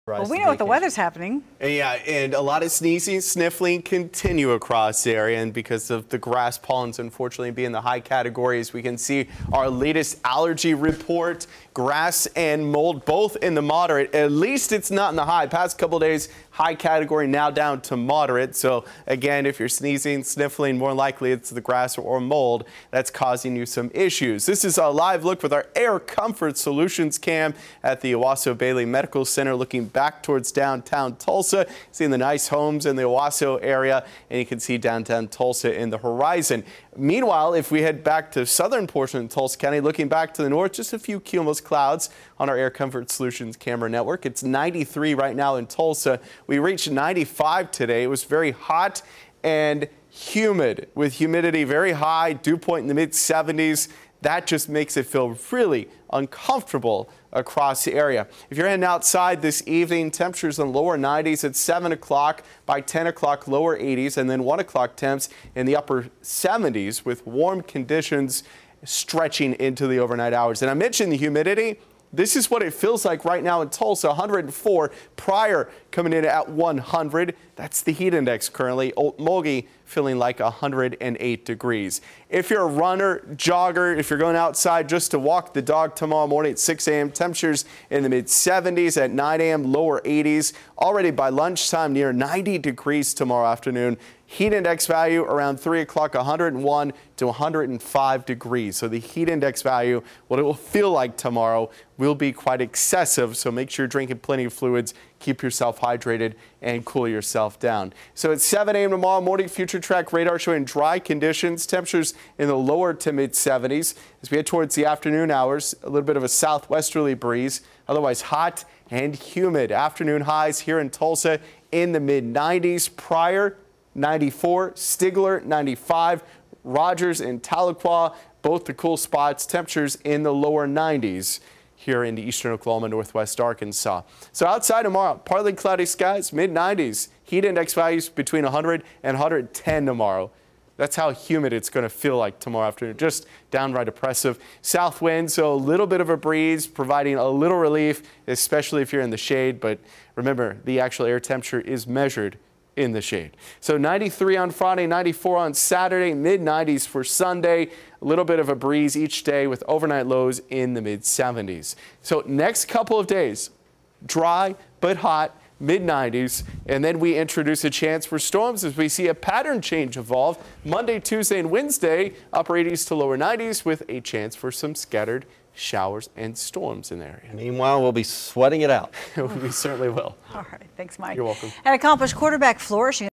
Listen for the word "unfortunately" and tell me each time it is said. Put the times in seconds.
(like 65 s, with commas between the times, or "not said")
6 s.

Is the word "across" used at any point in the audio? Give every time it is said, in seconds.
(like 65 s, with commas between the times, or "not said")
4 s, 57 s.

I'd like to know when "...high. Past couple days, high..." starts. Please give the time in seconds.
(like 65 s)
15 s.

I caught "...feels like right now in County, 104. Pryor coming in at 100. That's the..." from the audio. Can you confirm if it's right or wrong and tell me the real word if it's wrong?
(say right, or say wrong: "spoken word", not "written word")
wrong: "Tulsa", not "County".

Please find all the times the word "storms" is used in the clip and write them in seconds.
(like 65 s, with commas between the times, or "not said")
168 s, 176 s.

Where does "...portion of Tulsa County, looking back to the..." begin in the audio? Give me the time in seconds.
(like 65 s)
38 s.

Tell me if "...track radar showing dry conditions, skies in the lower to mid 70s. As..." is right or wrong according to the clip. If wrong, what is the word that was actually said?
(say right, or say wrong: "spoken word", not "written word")
wrong: "temperatures", not "skies".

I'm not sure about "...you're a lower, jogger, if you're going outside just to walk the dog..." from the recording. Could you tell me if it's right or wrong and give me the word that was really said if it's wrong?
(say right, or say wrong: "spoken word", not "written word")
wrong: "runner", not "lower".